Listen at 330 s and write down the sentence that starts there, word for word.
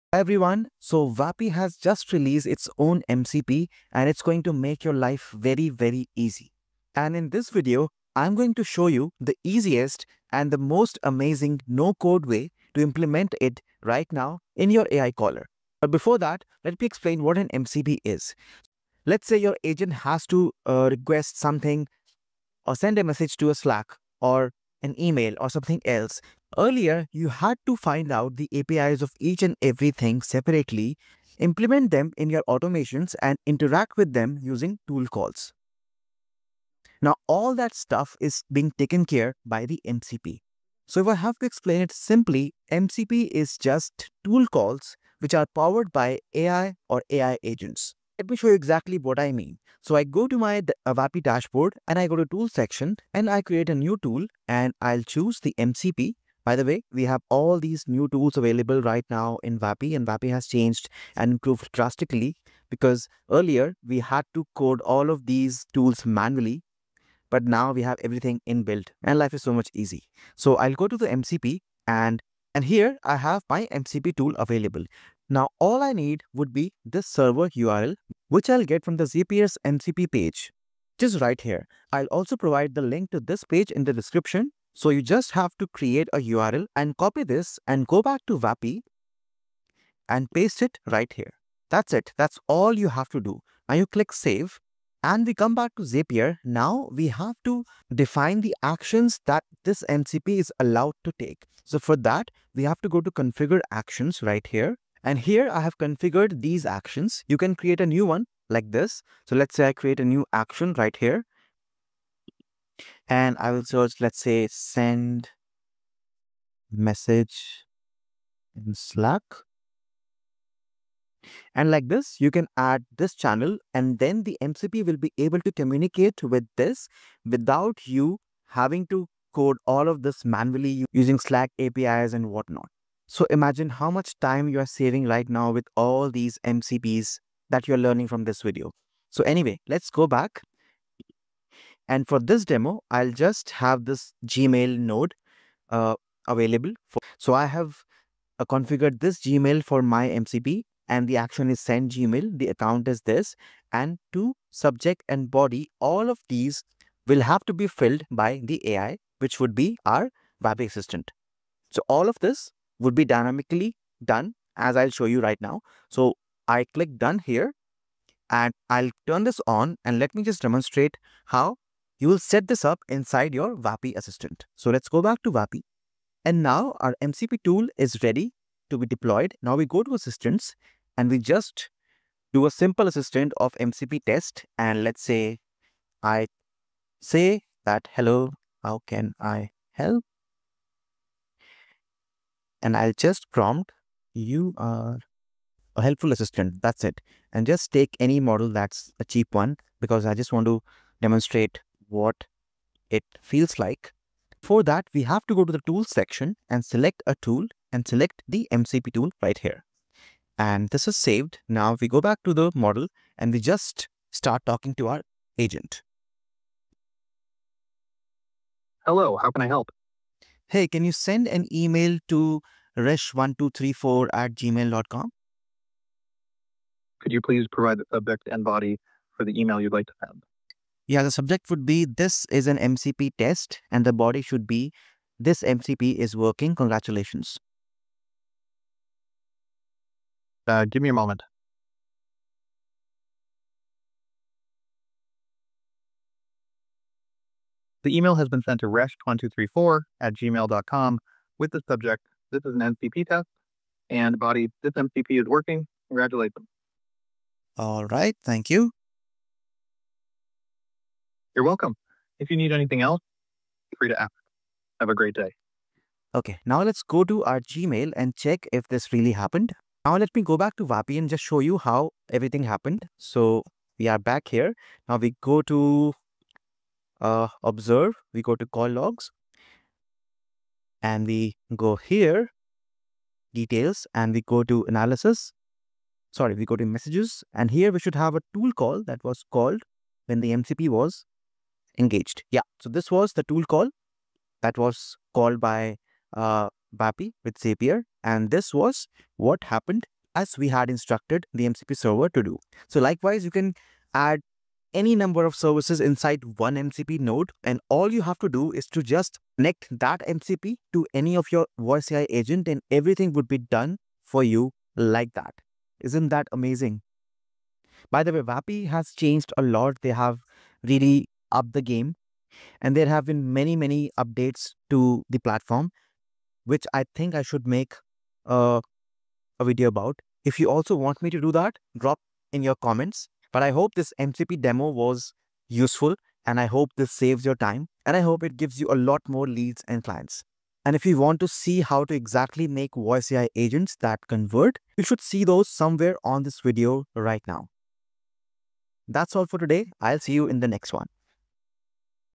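If you also want me to do that, drop in your comments.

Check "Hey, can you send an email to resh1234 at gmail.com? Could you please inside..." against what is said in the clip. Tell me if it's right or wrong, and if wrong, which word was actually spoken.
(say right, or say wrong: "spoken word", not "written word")
wrong: "provide", not "inside".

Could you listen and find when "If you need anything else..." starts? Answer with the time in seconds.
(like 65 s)
262 s.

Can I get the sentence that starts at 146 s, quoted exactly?
For, so I have uh, configured this Gmail for my MCP and the action is send Gmail.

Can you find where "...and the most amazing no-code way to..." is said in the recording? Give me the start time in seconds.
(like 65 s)
10 s.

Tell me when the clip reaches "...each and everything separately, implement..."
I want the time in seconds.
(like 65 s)
29 s.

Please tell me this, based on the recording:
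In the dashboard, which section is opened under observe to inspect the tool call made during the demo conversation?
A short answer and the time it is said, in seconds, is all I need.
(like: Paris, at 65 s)
Call logs, at 278 s.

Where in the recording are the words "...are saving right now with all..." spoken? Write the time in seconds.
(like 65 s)
134 s.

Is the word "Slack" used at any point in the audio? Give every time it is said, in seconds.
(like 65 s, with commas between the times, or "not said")
23 s, 118 s, 131 s.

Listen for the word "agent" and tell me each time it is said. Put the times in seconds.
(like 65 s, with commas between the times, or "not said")
19 s, 47 s, 215 s, 312 s, 343 s.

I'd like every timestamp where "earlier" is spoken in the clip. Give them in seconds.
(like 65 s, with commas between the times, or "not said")
26 s, 63 s.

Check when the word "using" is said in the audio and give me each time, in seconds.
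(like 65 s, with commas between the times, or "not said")
34 s, 130 s.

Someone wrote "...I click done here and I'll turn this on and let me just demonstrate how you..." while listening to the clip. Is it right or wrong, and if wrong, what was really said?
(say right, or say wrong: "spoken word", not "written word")
right.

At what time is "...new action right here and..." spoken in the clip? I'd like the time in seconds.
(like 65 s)
110 s.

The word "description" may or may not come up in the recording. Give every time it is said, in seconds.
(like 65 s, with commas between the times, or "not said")
83 s.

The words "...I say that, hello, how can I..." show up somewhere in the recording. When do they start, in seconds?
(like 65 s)
186 s.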